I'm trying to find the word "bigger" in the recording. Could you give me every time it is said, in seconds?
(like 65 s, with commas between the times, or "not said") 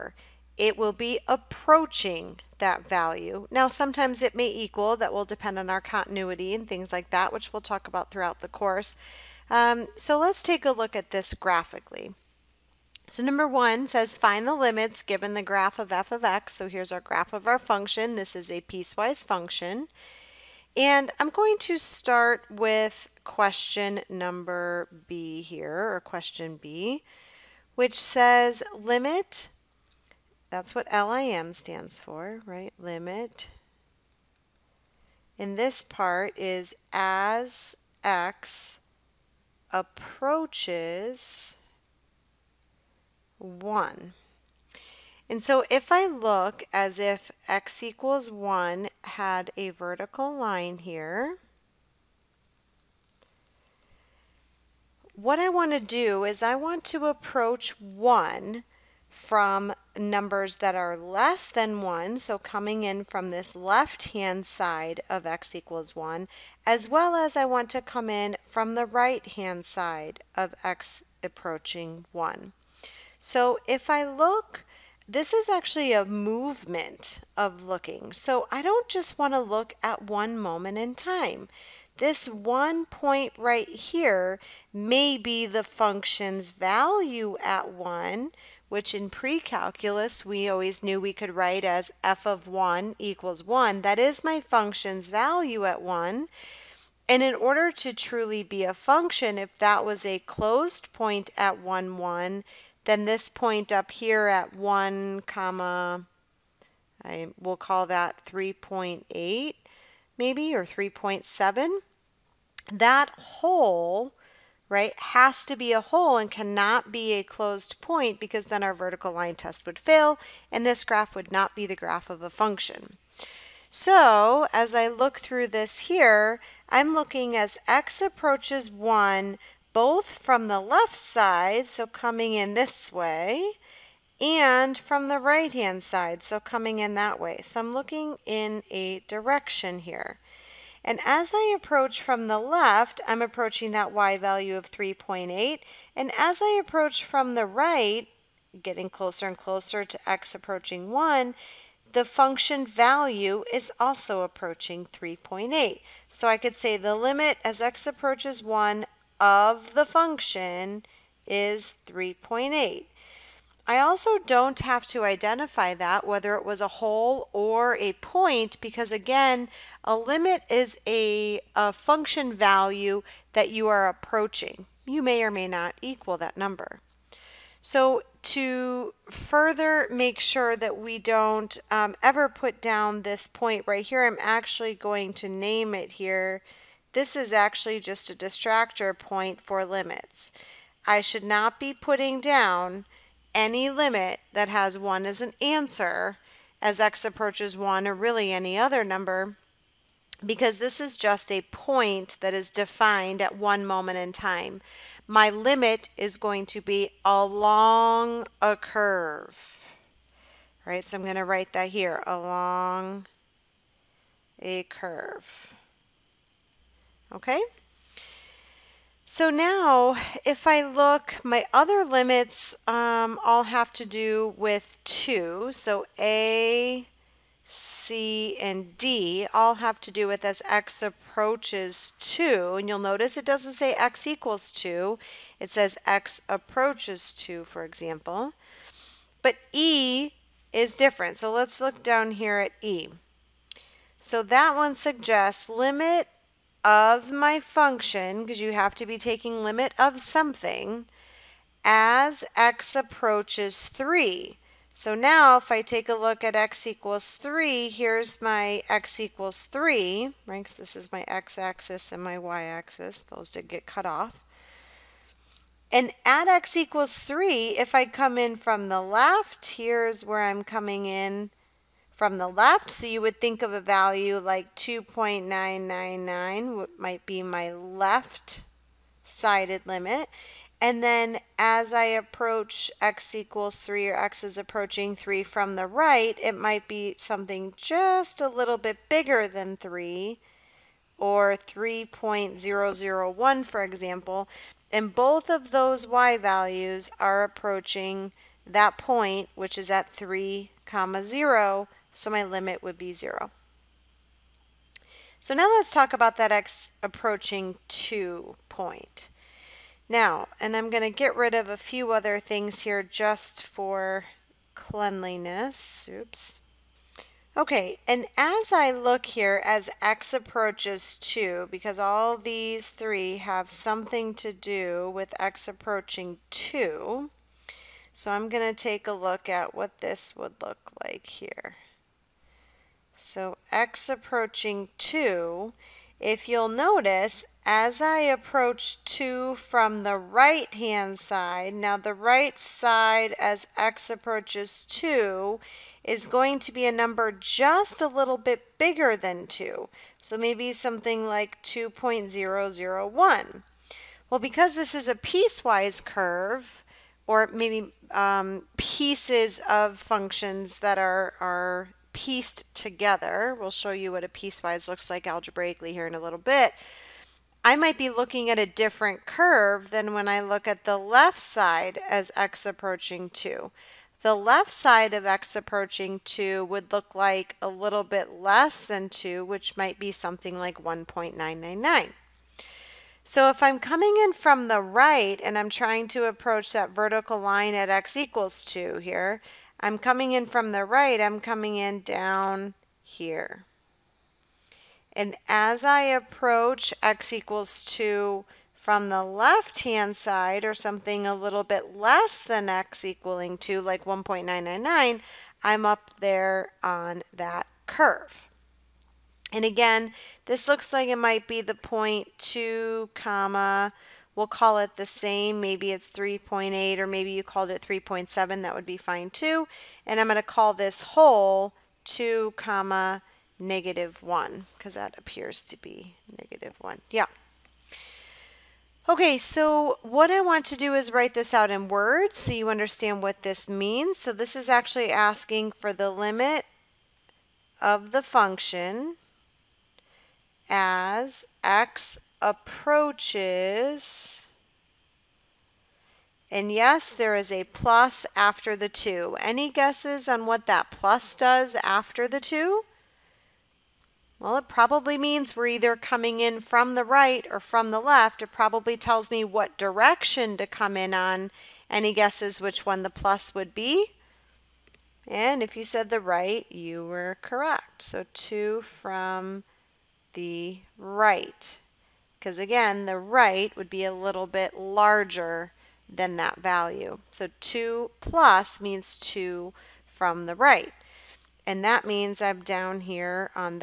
288 s, 348 s.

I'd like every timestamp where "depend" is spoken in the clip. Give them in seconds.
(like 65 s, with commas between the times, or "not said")
5 s.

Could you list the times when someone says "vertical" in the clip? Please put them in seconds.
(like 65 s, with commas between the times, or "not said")
49 s, 118 s, 386 s.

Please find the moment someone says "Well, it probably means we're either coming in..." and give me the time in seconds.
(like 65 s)
454 s.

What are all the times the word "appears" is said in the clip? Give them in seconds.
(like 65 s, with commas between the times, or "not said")
424 s.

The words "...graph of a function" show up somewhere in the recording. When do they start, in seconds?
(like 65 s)
121 s.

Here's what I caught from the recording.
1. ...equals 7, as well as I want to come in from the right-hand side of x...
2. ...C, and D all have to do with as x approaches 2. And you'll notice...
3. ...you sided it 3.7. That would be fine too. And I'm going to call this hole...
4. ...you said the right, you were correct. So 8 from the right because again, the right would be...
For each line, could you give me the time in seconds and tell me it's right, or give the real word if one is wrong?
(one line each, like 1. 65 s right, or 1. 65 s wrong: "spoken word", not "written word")
1. 65 s wrong: "1", not "7"
2. 227 s right
3. 417 s wrong: "called", not "sided"
4. 465 s wrong: "2", not "8".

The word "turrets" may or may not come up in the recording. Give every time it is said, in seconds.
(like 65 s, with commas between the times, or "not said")
not said.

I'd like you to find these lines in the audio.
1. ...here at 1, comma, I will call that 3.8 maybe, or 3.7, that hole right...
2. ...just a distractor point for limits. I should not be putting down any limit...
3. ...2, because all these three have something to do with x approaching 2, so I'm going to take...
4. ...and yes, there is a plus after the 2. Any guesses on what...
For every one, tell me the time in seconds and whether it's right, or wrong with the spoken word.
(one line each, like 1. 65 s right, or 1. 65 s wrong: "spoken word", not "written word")
1. 103 s right
2. 187 s right
3. 320 s right
4. 446 s right.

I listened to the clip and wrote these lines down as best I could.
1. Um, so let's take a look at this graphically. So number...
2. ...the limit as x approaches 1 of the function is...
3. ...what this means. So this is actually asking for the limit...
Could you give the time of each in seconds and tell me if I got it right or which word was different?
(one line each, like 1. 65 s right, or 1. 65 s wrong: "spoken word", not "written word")
1. 9 s right
2. 156 s right
3. 433 s right.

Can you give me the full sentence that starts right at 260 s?
this is my x-axis and my y-axis.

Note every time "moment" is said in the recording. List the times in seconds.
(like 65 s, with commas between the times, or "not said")
80 s, 203 s.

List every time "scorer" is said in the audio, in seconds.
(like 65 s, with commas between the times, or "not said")
not said.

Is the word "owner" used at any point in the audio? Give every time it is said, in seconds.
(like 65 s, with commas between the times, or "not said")
not said.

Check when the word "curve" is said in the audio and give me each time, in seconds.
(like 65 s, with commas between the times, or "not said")
208 s, 214 s, 355 s, 369 s, 407 s.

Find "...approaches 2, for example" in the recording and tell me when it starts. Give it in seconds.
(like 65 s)
236 s.